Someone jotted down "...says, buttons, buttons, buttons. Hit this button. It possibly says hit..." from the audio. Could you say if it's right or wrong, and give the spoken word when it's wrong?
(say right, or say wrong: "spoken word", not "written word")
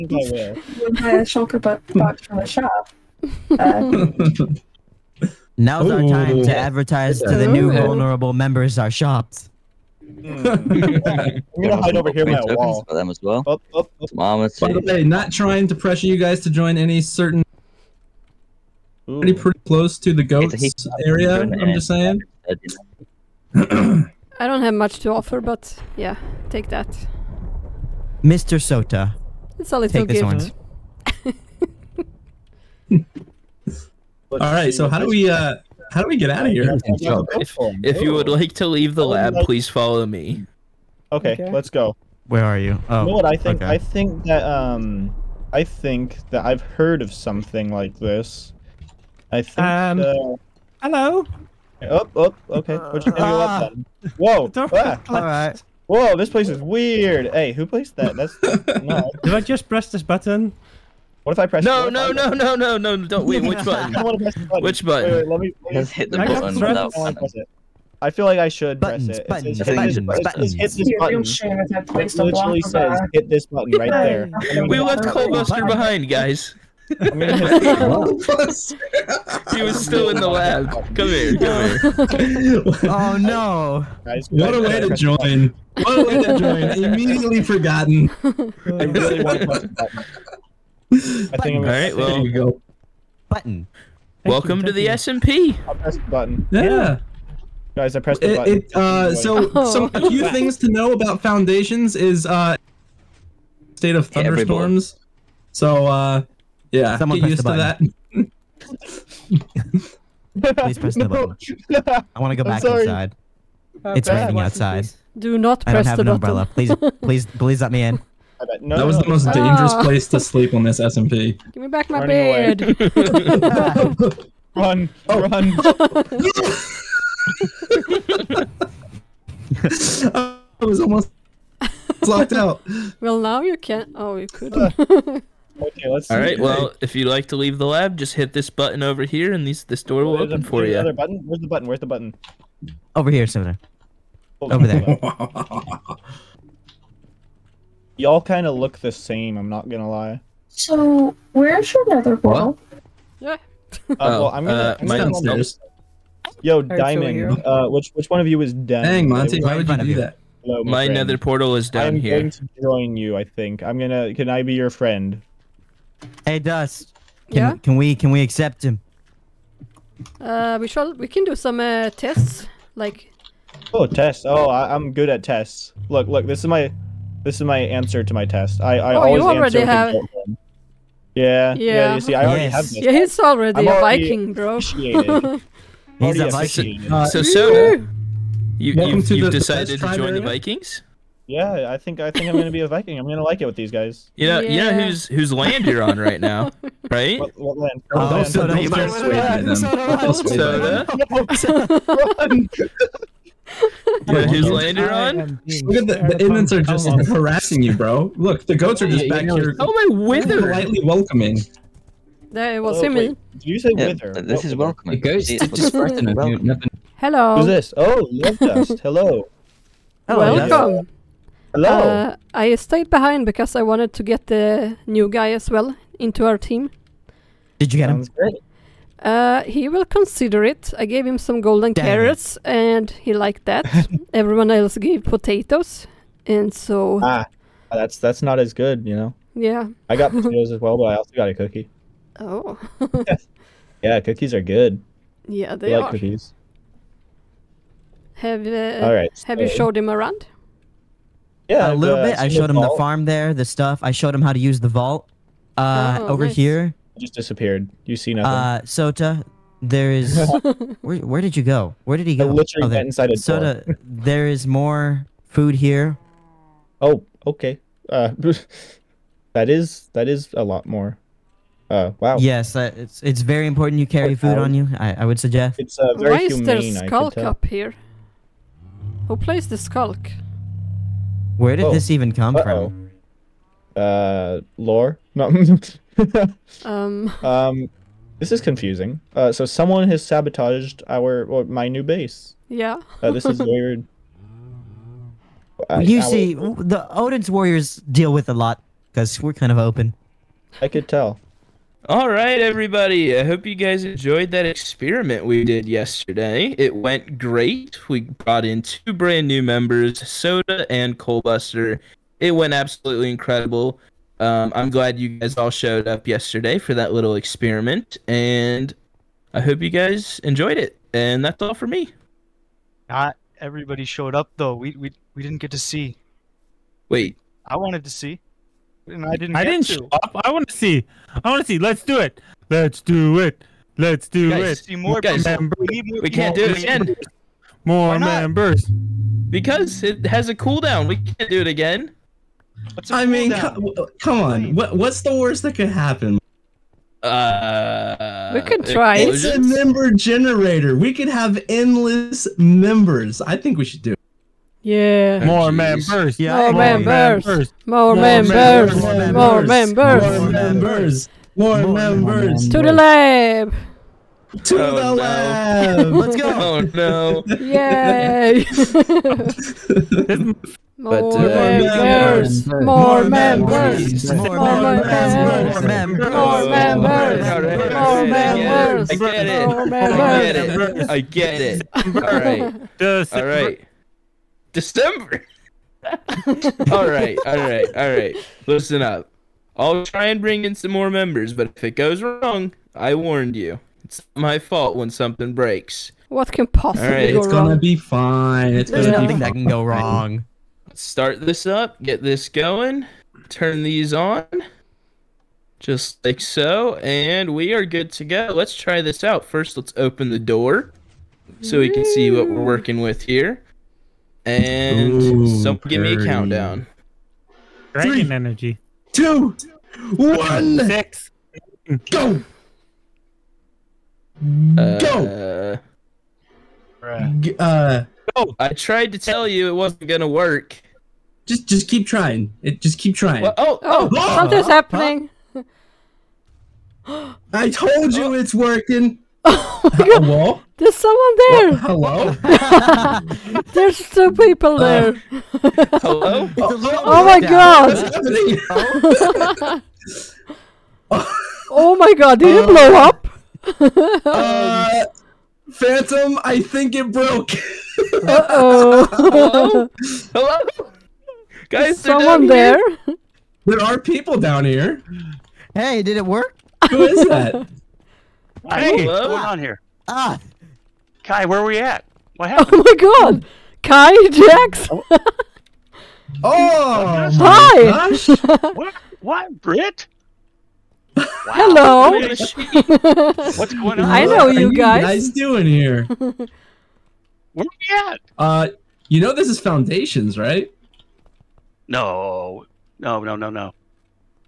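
wrong: "literally", not "possibly".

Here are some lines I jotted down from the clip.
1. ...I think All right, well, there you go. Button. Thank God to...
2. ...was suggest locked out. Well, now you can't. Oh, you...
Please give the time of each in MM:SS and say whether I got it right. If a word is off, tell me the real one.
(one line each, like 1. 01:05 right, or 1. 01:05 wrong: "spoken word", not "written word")
1. 01:30 wrong: "Welcome", not "God"
2. 02:10 wrong: "almost", not "suggest".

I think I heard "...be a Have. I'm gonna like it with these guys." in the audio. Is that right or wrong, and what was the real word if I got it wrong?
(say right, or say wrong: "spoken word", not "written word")
wrong: "Viking", not "Have".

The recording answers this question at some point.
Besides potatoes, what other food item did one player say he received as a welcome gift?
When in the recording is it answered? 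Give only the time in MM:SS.
04:01.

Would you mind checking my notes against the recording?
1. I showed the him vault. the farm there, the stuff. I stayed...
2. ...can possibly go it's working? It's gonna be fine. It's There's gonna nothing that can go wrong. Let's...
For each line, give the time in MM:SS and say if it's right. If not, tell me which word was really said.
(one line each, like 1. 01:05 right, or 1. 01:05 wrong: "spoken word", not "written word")
1. 04:12 wrong: "showed", not "stayed"
2. 06:36 wrong: "wrong", not "working".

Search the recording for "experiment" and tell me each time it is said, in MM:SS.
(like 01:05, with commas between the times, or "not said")
05:04, 05:17.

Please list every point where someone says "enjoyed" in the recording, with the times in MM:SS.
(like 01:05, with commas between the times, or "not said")
05:03, 05:20.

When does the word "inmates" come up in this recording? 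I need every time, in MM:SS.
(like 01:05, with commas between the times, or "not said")
03:26.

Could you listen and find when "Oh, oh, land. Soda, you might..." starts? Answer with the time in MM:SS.
03:17.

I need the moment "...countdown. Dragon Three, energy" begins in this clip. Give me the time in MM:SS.
06:56.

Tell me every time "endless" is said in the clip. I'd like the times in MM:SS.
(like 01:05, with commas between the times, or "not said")
05:51.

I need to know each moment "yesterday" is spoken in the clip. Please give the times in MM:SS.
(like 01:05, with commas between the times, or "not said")
05:05, 05:16.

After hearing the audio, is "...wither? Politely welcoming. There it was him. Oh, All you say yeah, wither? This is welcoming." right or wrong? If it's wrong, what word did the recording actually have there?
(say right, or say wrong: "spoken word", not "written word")
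wrong: "Did", not "All".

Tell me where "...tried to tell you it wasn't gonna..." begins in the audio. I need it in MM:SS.
07:08.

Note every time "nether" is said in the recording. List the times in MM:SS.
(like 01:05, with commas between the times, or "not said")
02:31, 02:40.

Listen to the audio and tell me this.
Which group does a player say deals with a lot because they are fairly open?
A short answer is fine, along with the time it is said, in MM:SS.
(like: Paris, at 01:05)
Odin's warriors, at 04:56.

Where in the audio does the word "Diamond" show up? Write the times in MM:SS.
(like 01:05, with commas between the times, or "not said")
02:36.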